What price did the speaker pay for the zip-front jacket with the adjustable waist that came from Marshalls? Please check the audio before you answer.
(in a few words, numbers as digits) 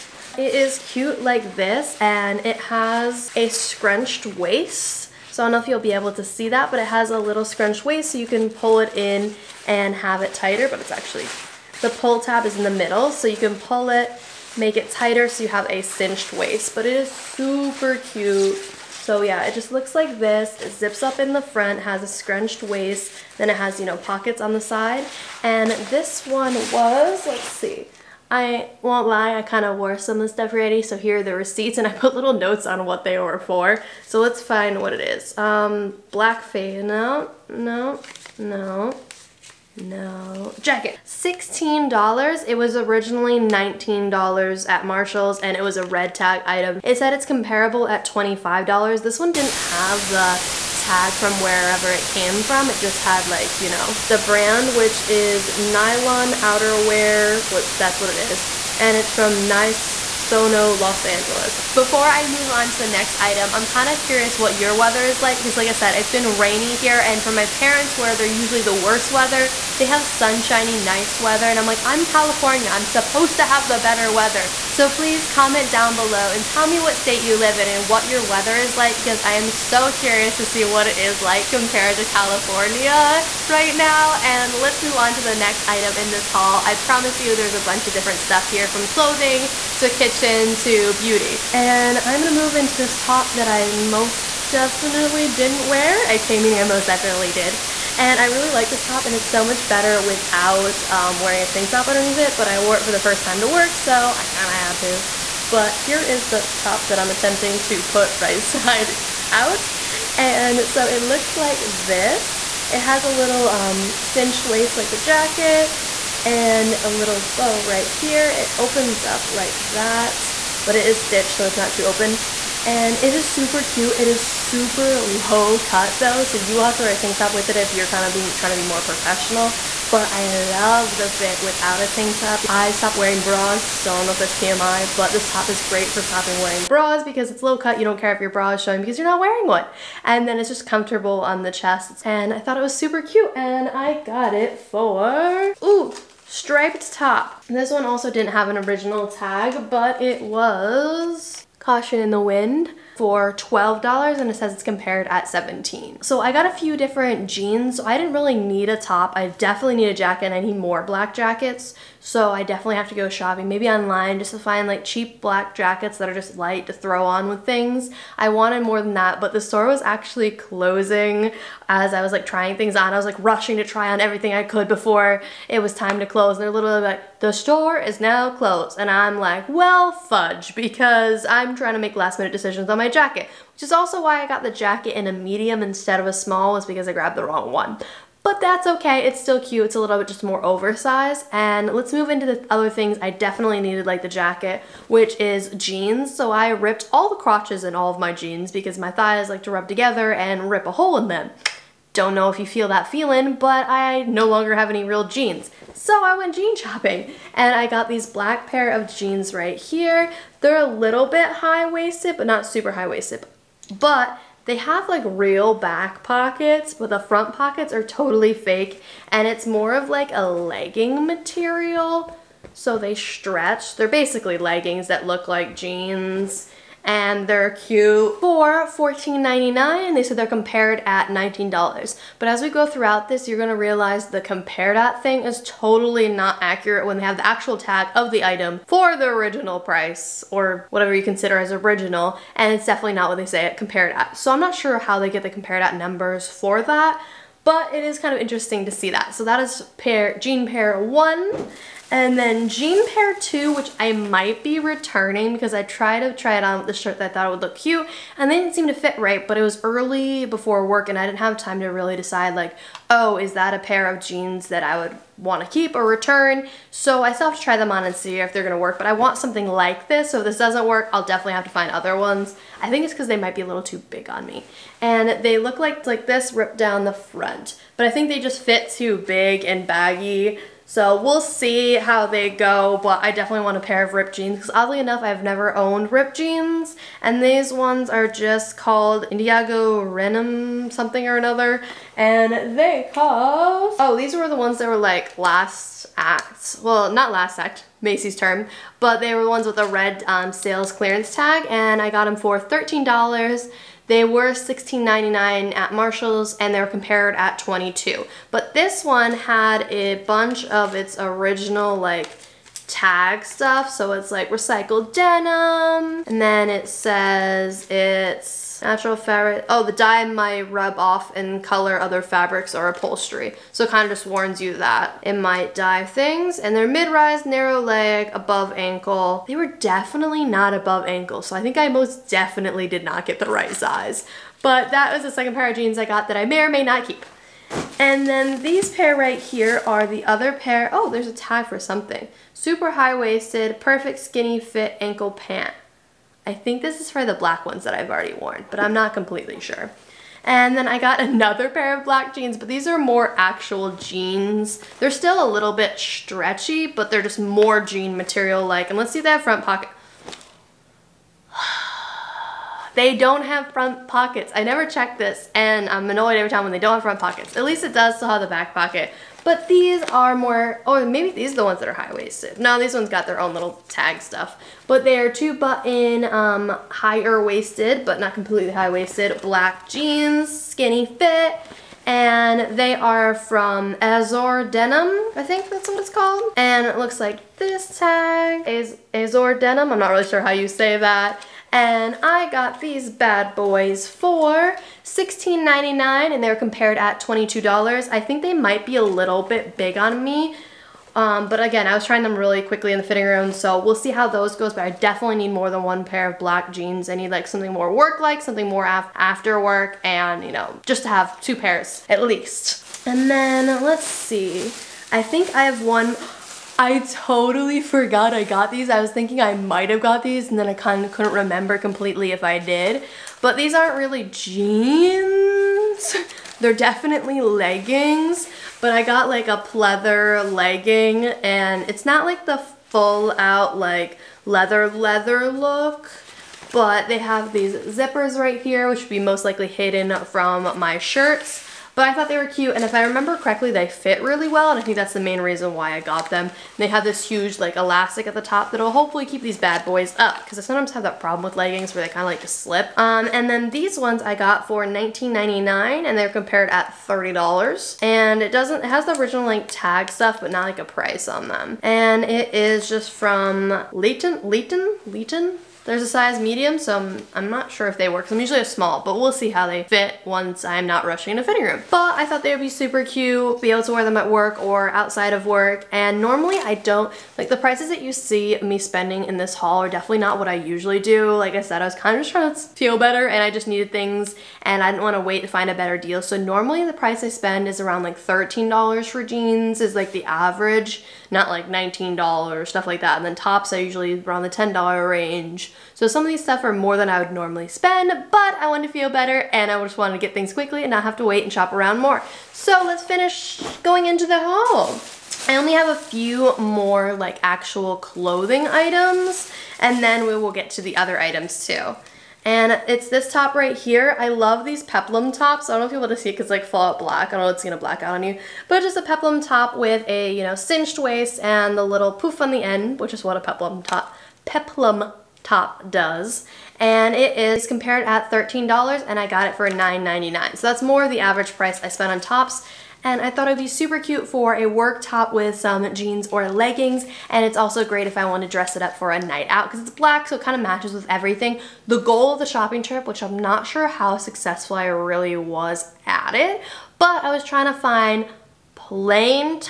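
$16.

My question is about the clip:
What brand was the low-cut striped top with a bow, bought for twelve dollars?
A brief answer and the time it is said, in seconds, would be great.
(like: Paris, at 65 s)
Caution in the Wind, at 151 s.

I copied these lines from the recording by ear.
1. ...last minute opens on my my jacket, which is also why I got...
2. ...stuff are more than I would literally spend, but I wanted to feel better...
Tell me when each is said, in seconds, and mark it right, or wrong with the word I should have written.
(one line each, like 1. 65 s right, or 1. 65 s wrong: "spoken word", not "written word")
1. 181 s wrong: "decisions", not "opens"
2. 496 s wrong: "normally", not "literally".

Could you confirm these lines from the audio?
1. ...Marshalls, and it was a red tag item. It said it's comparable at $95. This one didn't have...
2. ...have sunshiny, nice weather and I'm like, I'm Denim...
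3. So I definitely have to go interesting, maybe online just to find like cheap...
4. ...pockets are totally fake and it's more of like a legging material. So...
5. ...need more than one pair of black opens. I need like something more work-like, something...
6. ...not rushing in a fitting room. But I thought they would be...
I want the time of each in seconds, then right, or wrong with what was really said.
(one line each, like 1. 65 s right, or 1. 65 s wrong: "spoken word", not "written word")
1. 44 s wrong: "25", not "95"
2. 69 s wrong: "California", not "Denim"
3. 161 s wrong: "shopping", not "interesting"
4. 217 s right
5. 405 s wrong: "jeans", not "opens"
6. 470 s right.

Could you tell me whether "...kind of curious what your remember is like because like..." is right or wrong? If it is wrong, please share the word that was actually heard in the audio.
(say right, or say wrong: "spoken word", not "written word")
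wrong: "weather", not "remember".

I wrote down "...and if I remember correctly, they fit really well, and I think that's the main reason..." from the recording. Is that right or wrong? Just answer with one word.
right.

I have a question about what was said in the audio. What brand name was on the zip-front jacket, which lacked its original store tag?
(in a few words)
Nylon Outerwear.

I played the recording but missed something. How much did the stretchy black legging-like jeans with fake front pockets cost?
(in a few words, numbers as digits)
$14.99.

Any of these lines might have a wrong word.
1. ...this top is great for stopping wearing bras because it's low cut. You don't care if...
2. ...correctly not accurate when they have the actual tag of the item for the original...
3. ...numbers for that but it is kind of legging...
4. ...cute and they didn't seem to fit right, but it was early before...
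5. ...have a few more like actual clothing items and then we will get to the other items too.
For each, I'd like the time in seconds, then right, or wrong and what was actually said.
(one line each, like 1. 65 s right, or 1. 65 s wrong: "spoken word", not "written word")
1. 135 s right
2. 235 s wrong: "totally", not "correctly"
3. 245 s wrong: "interesting", not "legging"
4. 257 s right
5. 505 s right.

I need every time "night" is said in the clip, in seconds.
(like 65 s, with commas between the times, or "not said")
539 s.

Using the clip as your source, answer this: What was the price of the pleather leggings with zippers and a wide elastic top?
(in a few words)
$19.99.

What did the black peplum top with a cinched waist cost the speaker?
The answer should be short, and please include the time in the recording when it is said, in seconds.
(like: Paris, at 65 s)
$9.99, at 529 s.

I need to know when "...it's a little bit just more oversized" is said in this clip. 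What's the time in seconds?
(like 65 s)
189 s.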